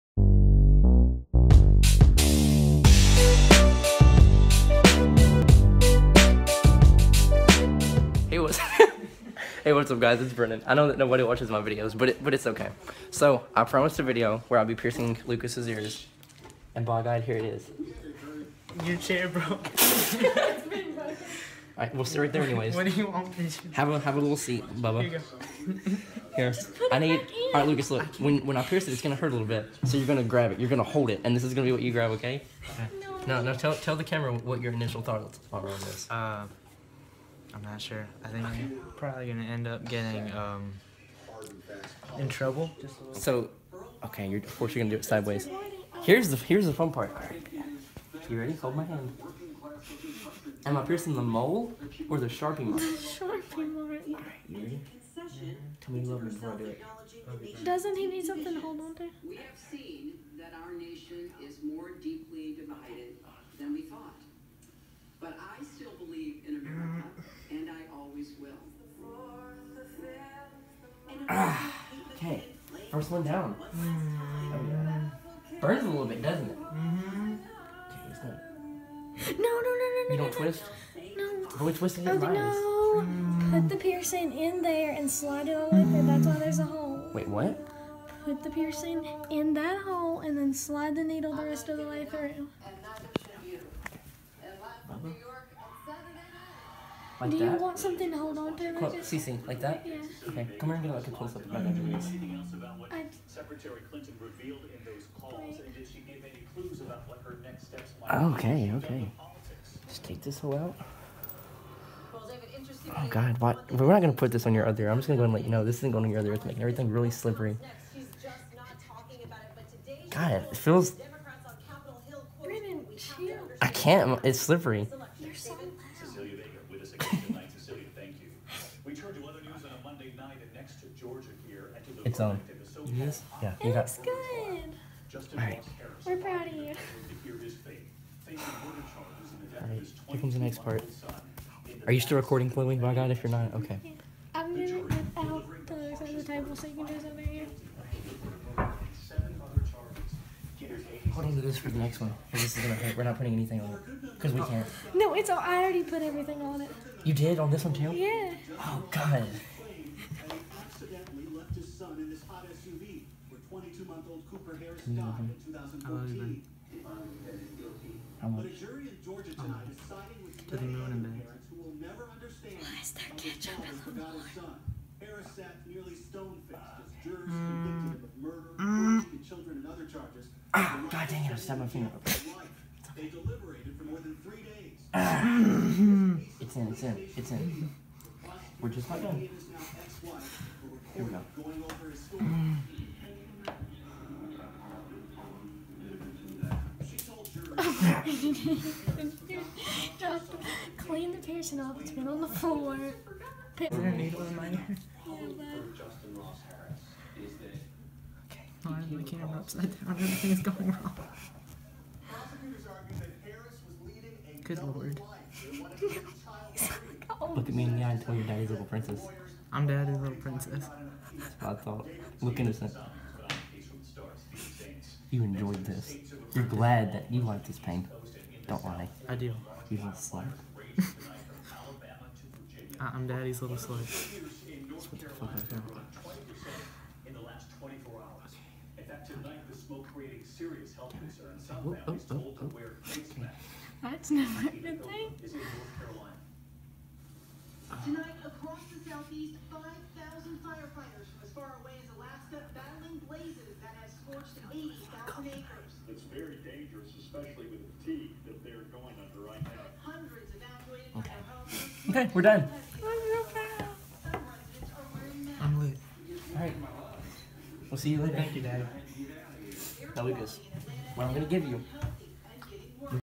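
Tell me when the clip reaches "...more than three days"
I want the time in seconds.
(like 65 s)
183 s.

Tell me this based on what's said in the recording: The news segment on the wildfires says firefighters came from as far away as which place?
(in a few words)
Alaska.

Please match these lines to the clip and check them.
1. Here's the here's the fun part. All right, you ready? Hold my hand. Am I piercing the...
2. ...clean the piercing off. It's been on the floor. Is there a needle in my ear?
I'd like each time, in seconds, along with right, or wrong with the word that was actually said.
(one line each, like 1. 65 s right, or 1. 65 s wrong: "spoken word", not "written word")
1. 46 s right
2. 200 s right.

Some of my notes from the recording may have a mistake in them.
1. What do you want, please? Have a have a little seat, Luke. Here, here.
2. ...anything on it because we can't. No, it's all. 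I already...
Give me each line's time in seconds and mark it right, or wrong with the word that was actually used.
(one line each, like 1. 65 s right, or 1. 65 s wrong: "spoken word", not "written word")
1. 22 s wrong: "Bubba", not "Luke"
2. 153 s right.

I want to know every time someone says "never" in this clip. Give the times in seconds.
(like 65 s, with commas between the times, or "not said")
171 s, 244 s.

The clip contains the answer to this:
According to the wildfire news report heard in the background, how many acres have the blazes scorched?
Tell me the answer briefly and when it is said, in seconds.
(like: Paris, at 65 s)
80,000 acres, at 254 s.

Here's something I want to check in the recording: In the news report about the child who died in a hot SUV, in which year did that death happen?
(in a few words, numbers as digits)
2014.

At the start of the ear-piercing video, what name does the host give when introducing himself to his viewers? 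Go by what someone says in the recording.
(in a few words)
Brennan.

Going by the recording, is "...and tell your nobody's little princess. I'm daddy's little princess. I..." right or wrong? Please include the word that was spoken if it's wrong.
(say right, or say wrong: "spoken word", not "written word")
wrong: "daddy", not "nobody".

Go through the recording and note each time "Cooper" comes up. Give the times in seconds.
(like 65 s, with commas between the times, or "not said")
164 s.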